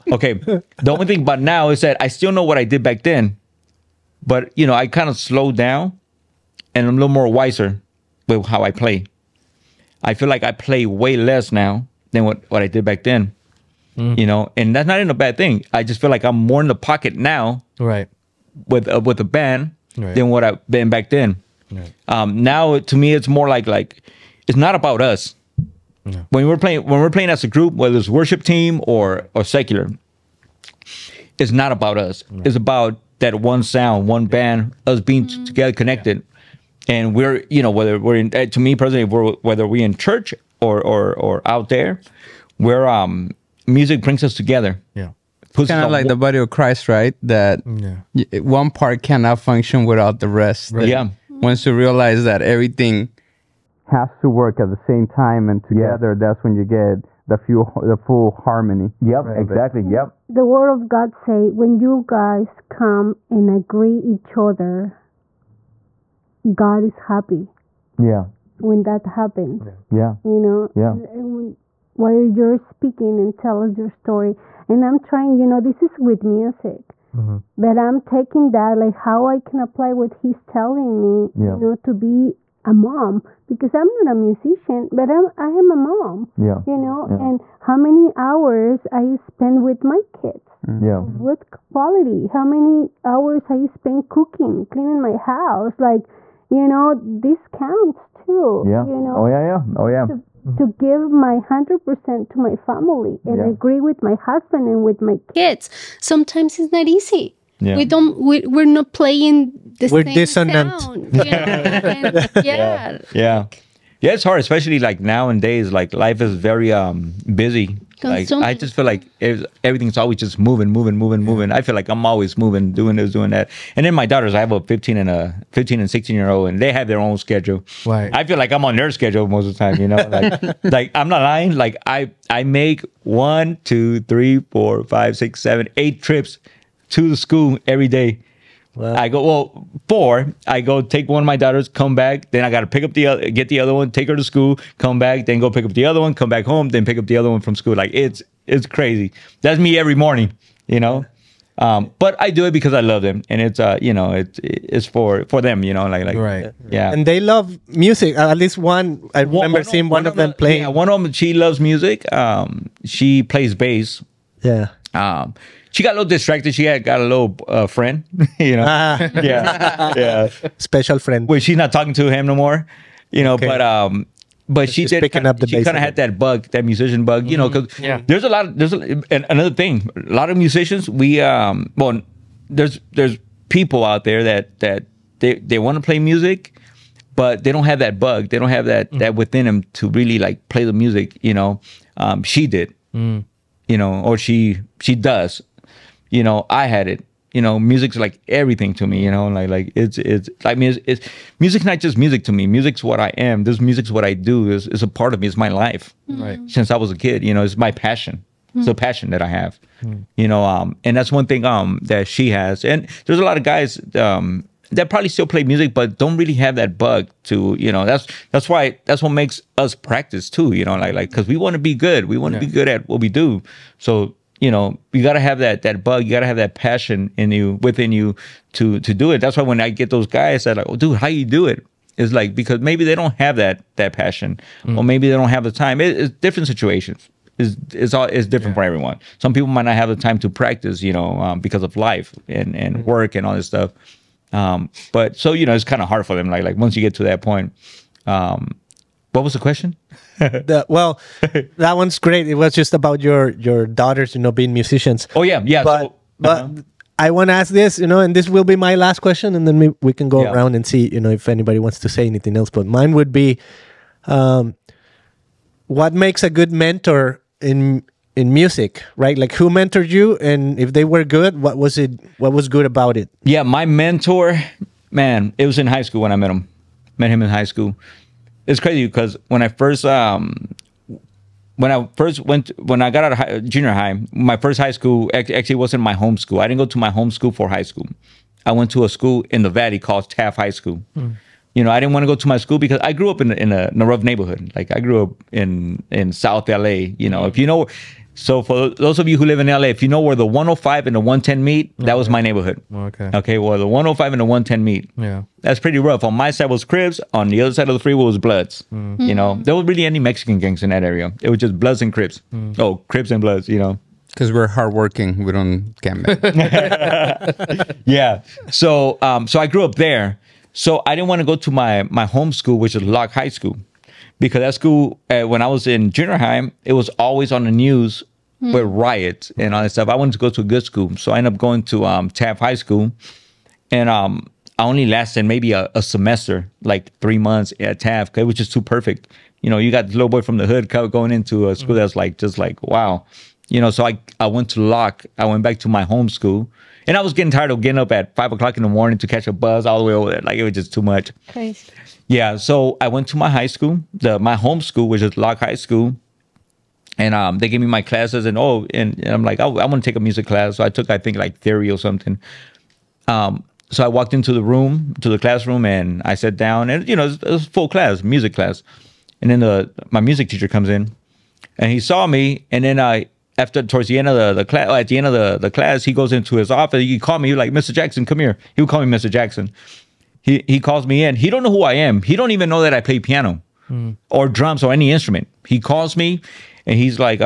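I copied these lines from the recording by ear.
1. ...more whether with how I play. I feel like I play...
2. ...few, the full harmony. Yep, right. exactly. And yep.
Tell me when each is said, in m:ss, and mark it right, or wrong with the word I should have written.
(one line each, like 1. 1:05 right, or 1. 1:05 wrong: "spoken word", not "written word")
1. 0:07 wrong: "wiser", not "whether"
2. 0:57 right.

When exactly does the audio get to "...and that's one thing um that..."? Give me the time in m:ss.
3:30.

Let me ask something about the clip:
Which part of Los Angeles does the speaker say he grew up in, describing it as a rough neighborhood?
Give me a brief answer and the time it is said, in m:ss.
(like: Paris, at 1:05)
South LA, at 4:56.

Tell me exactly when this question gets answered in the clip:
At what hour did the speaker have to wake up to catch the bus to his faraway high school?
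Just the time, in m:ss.
5:48.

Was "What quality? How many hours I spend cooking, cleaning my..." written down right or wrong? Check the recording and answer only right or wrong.
right.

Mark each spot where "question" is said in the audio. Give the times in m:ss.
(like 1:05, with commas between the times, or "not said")
4:09, 4:19.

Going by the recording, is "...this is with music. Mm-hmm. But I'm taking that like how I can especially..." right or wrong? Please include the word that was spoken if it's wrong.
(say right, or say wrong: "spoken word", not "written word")
wrong: "apply", not "especially".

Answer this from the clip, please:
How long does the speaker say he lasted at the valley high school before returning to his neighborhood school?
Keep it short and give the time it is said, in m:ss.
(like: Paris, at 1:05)
3 months, at 5:36.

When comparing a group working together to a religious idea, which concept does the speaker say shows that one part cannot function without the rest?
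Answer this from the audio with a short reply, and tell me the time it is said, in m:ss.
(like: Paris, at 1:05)
Body of Christ, at 0:46.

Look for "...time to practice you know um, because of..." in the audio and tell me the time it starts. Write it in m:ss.
3:59.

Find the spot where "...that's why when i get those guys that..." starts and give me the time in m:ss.
3:49.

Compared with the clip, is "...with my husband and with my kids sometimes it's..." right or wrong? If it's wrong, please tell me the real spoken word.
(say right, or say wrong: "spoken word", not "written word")
right.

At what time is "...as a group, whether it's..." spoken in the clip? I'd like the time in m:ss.
0:27.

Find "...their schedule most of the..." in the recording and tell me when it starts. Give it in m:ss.
2:08.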